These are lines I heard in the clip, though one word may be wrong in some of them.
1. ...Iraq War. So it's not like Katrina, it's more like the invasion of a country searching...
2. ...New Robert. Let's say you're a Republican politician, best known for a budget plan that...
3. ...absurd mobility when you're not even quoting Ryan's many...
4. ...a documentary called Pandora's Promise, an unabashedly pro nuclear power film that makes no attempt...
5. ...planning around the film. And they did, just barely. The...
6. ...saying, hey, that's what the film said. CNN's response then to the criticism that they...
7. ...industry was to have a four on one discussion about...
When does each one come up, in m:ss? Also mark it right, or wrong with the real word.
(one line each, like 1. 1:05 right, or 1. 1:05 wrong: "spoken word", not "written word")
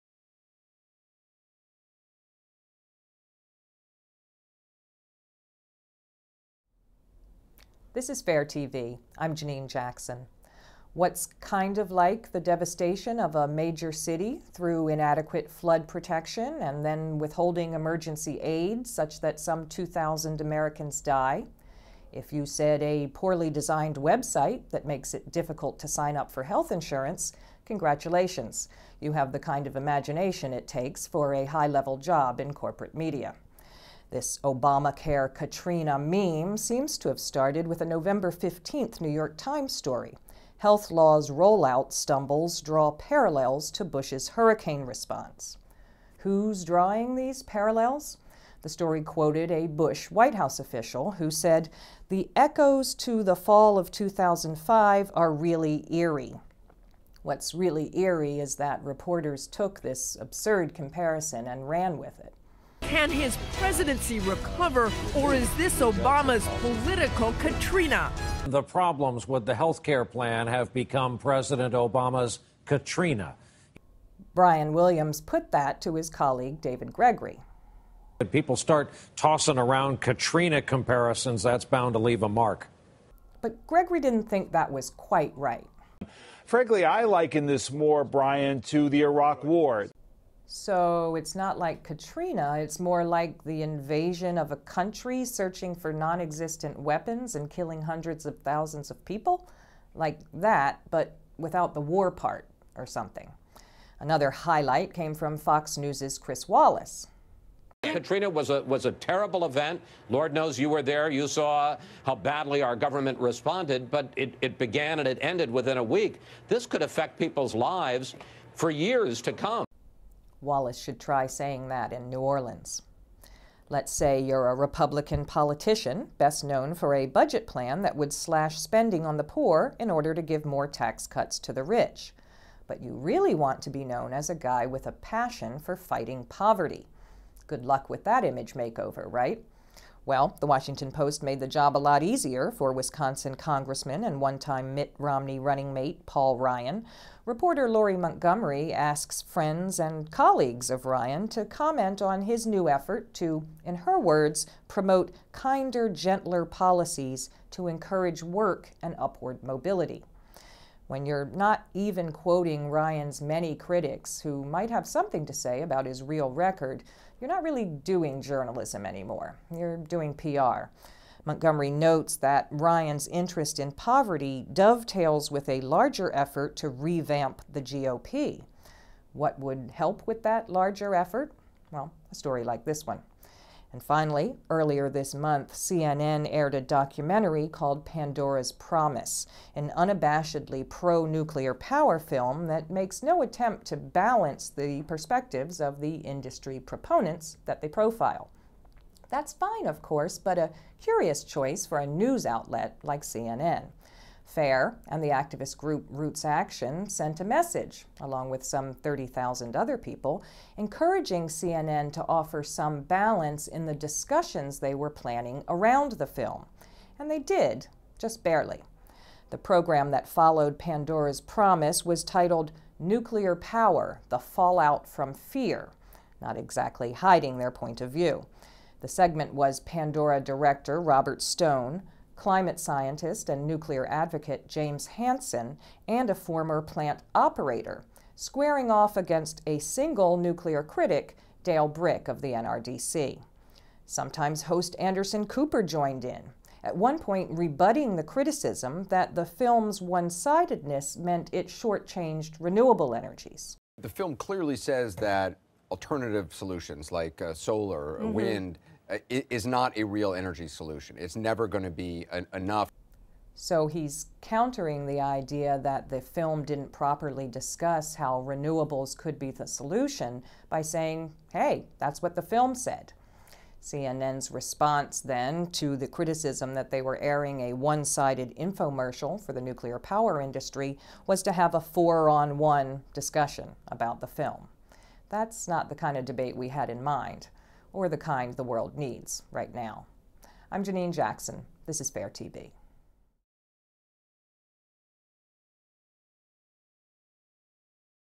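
1. 1:29 right
2. 2:02 wrong: "Orleans", not "Robert"
3. 2:38 wrong: "upward", not "absurd"
4. 3:06 right
5. 3:34 right
6. 4:30 right
7. 4:40 right.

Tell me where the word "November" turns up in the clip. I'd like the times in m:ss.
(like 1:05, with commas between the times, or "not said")
0:37.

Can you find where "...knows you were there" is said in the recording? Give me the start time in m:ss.
1:50.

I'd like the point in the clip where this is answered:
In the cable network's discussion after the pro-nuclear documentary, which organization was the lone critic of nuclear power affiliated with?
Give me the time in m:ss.
4:02.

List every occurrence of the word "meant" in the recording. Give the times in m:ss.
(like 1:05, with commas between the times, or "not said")
4:10.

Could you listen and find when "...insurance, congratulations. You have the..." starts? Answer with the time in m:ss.
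0:26.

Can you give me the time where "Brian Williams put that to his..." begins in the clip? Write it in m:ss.
1:14.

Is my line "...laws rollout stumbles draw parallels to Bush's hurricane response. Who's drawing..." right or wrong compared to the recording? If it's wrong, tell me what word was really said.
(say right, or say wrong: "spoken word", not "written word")
right.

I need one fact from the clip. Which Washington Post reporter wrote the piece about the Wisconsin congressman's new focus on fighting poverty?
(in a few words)
Lori Montgomery.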